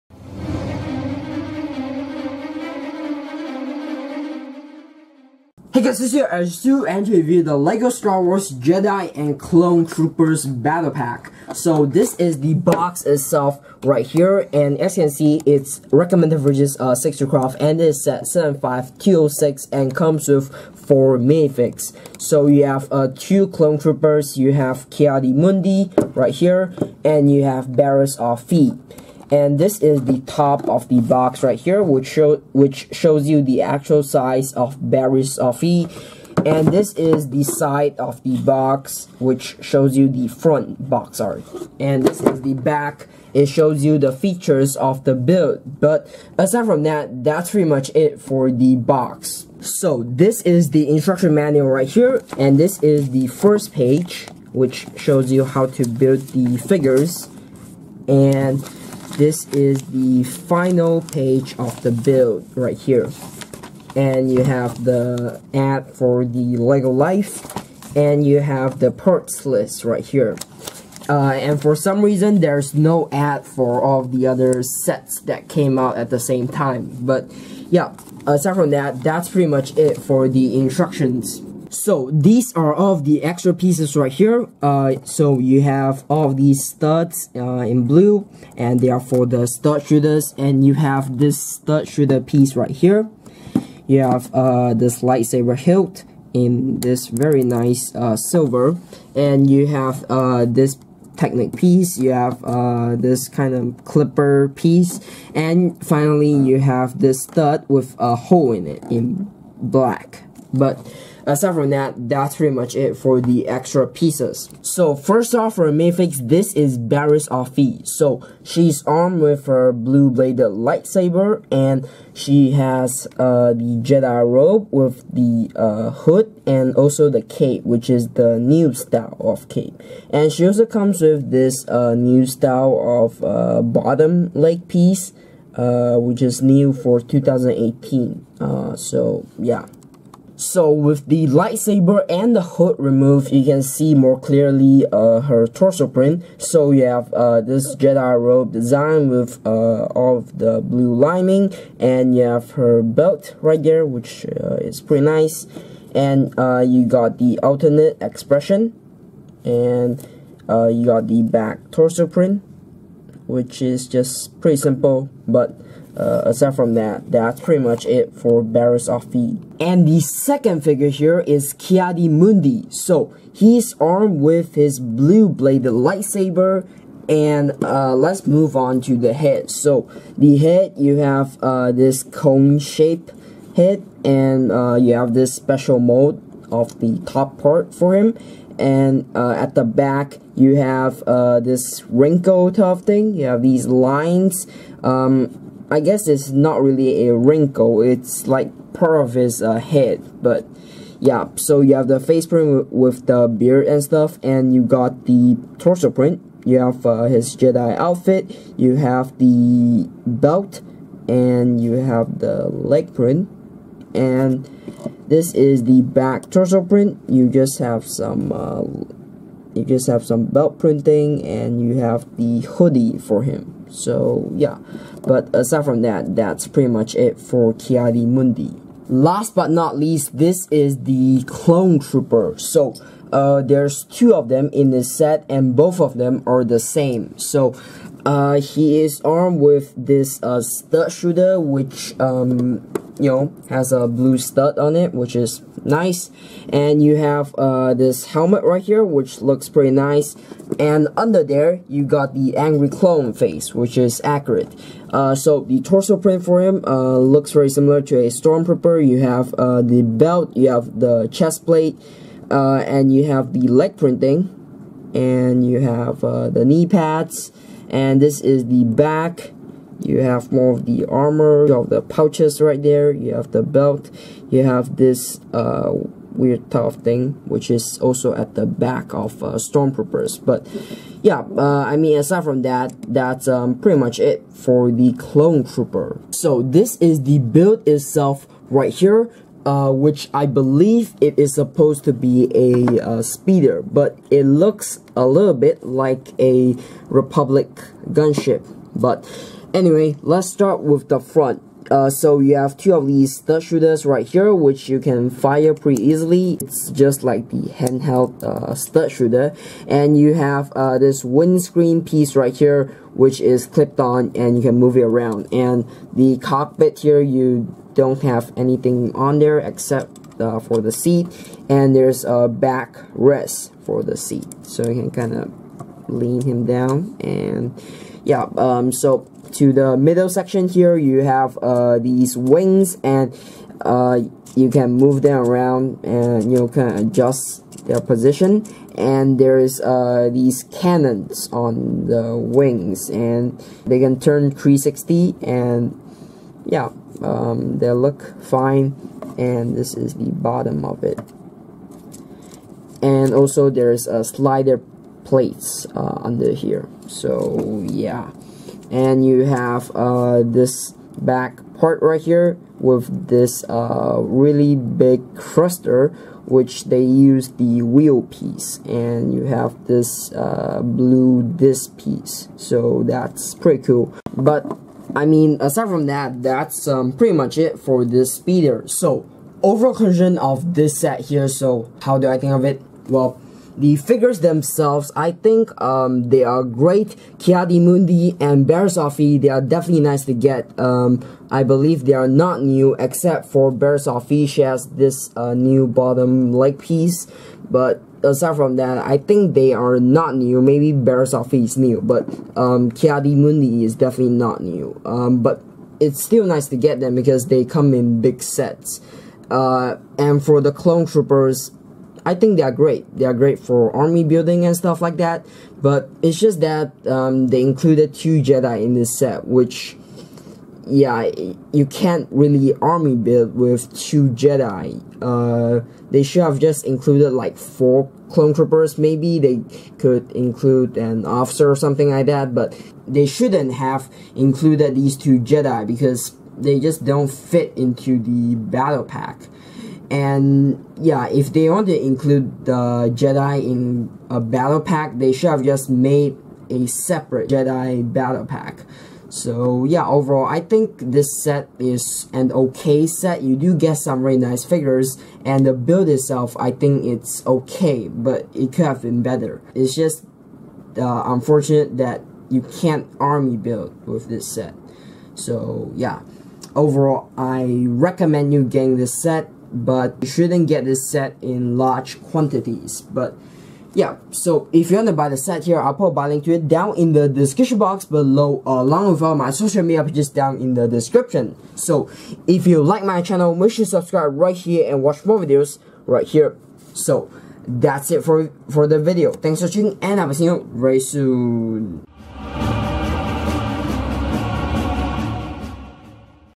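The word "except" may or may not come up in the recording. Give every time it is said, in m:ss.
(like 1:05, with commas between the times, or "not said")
5:19, 6:32.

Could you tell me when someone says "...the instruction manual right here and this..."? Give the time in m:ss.
0:50.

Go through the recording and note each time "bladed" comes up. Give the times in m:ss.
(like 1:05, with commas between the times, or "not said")
2:00, 2:55.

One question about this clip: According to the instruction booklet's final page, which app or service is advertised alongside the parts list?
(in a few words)
Lego Life.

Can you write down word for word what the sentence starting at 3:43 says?
So yeah, but aside from that, that's pretty much it for Ki-Adi-Mundi.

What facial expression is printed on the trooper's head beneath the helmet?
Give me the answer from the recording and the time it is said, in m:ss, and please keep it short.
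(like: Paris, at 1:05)
Angry clone face, at 4:12.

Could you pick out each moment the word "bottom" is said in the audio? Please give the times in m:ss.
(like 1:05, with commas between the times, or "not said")
2:13, 5:50, 6:35.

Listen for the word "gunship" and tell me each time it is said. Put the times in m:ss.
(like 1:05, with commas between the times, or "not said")
4:57.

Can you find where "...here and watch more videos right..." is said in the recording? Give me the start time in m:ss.
8:04.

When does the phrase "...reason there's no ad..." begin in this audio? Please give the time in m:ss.
1:12.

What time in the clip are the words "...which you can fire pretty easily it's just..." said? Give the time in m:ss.
5:04.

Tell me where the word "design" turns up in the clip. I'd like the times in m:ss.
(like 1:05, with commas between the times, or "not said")
2:28.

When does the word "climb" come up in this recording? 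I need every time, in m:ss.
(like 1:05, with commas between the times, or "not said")
not said.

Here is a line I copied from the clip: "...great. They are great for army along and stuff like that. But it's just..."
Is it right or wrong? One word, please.
wrong.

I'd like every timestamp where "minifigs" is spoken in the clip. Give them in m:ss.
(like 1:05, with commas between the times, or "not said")
0:21, 1:55.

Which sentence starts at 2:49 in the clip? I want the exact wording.
And the second figure here is Ki-Adi-Mundi.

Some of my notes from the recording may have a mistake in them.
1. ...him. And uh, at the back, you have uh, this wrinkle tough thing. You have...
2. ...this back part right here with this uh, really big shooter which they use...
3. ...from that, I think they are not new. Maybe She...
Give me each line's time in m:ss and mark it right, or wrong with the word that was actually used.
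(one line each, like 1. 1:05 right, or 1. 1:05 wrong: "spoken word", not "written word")
1. 3:07 right
2. 6:00 wrong: "thruster", not "shooter"
3. 6:38 wrong: "Bear", not "She".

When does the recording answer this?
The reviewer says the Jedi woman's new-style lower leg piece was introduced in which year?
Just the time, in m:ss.
2:16.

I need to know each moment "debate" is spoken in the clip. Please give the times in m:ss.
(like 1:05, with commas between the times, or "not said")
not said.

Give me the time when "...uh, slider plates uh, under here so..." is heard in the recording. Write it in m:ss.
5:53.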